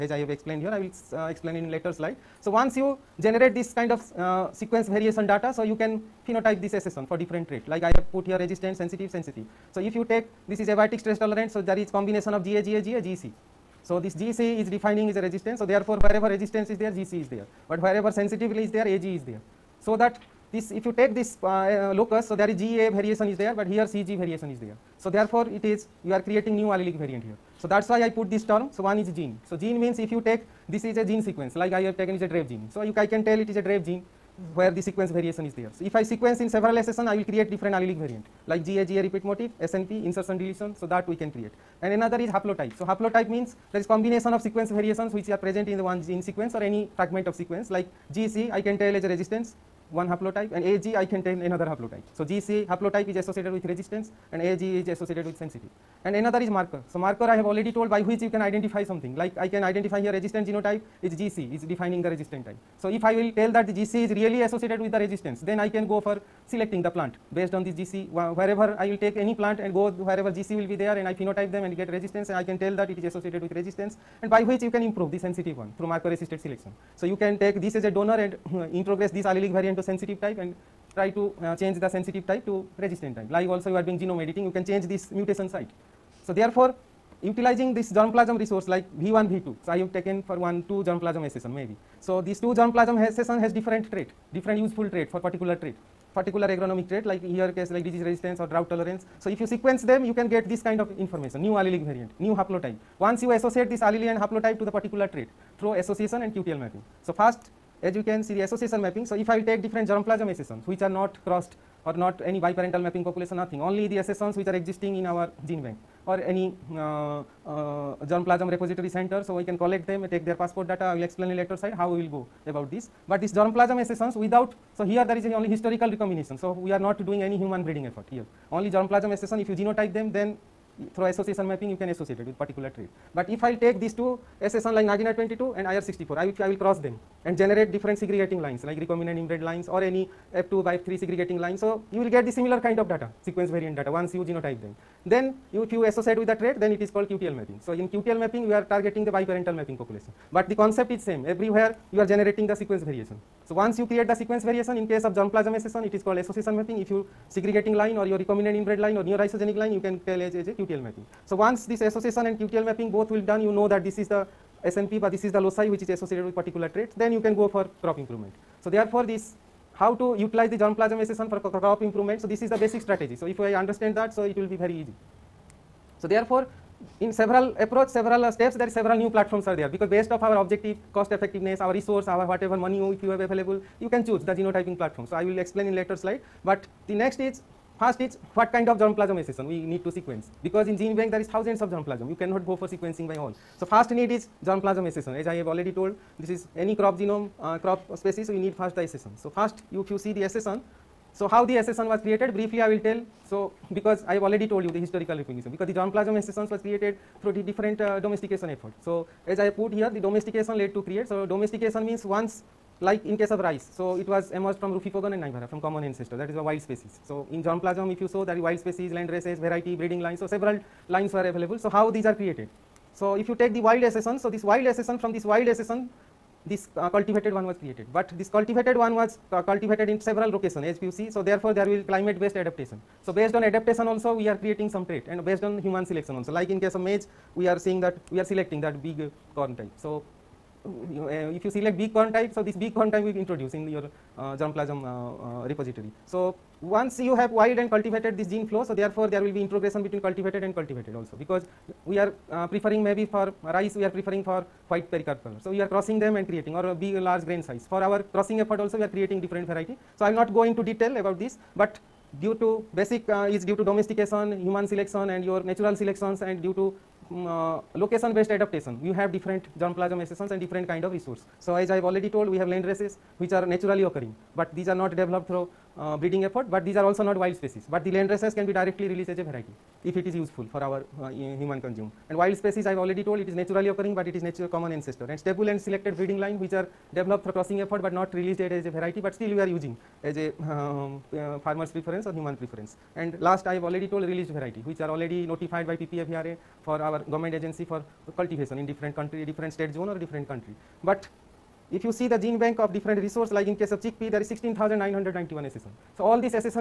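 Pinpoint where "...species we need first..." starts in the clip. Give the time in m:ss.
3:17.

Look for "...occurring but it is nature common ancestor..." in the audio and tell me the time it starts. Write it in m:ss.
4:43.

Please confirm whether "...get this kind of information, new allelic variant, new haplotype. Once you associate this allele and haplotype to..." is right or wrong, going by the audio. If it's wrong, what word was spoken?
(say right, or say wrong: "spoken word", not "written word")
right.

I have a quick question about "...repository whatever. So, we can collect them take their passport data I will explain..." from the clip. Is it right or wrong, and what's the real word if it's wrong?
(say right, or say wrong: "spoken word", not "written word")
wrong: "center", not "whatever".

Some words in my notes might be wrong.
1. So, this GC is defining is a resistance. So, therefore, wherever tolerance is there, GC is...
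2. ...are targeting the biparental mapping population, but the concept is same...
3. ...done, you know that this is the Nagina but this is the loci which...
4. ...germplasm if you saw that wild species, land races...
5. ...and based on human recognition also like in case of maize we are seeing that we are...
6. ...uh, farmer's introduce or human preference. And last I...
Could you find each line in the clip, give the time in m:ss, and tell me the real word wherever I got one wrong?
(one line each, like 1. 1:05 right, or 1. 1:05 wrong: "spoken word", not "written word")
1. 0:13 wrong: "resistance", not "tolerance"
2. 2:28 right
3. 2:43 wrong: "SNP", not "Nagina"
4. 3:37 right
5. 3:55 wrong: "selection", not "recognition"
6. 4:51 wrong: "preference", not "introduce".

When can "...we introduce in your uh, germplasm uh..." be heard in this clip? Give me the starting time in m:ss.
4:03.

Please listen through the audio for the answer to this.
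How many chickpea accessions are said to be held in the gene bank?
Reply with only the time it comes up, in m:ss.
5:04.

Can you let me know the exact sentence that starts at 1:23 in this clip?
Like also you are doing genome editing, you can change this mutation site so, therefore, utilizing this germplasm resource like V1, V2.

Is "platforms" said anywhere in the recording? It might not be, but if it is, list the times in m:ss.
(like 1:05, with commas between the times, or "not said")
2:59, 3:04.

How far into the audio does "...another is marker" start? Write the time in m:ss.
0:56.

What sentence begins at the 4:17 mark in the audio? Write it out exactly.
For our crossing effort also we are creating different variety.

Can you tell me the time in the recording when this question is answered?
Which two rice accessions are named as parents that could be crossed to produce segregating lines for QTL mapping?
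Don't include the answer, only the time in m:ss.
2:14.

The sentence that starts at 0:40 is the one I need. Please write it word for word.
So, that we can create and another is haplotype.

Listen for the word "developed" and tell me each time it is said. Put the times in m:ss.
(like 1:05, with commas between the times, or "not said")
4:34, 4:46.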